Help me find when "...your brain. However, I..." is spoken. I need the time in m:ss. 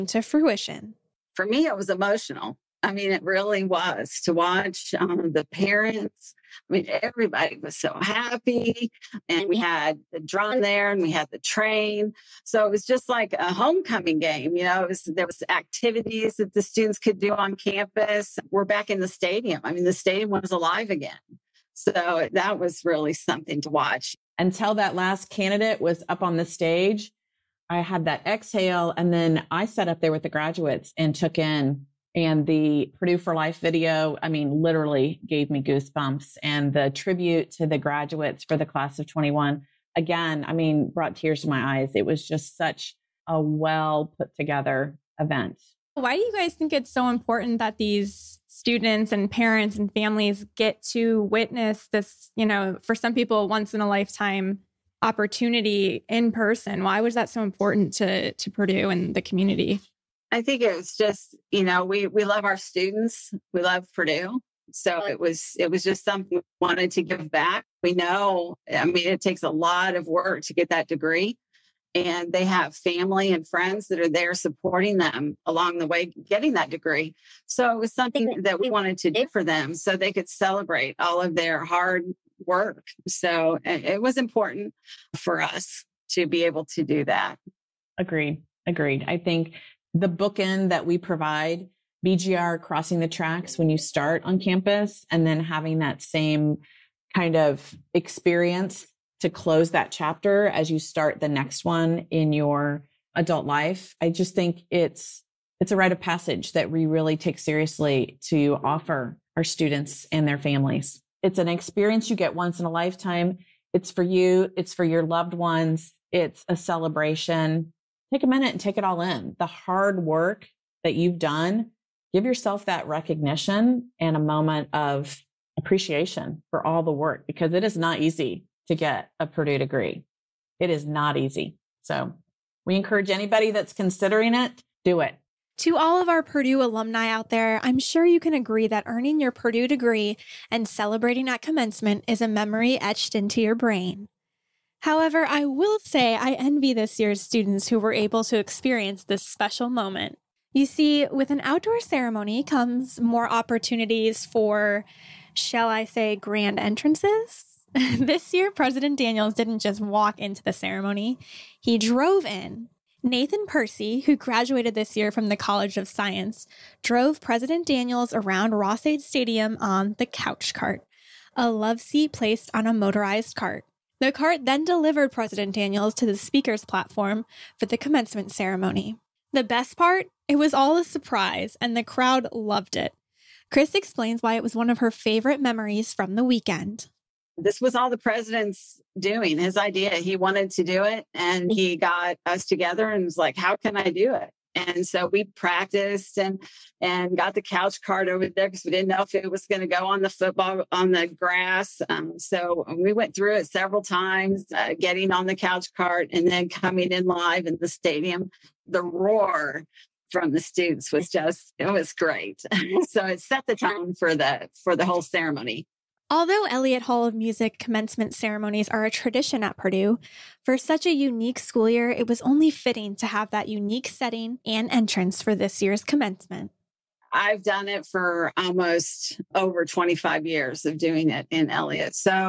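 2:23.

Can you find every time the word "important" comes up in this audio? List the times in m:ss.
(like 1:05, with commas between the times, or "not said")
0:47, 0:57, 1:24.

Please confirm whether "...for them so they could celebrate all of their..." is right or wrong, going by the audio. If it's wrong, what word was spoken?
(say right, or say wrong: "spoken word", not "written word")
right.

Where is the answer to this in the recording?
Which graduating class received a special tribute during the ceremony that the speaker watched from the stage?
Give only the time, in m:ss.
0:38.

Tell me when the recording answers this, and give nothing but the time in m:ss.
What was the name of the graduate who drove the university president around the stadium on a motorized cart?
2:43.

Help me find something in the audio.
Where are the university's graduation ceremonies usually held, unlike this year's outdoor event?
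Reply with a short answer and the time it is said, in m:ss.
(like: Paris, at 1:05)
Elliott Hall of Music, at 3:36.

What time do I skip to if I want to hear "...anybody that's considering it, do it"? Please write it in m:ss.
2:13.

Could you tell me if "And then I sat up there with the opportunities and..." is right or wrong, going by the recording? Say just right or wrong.
wrong.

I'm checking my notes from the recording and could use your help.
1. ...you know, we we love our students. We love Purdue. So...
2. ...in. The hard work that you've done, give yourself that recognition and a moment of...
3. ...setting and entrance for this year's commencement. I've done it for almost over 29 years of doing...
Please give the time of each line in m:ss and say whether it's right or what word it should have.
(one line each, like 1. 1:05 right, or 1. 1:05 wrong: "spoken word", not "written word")
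1. 1:01 right
2. 1:59 right
3. 3:43 wrong: "25", not "29".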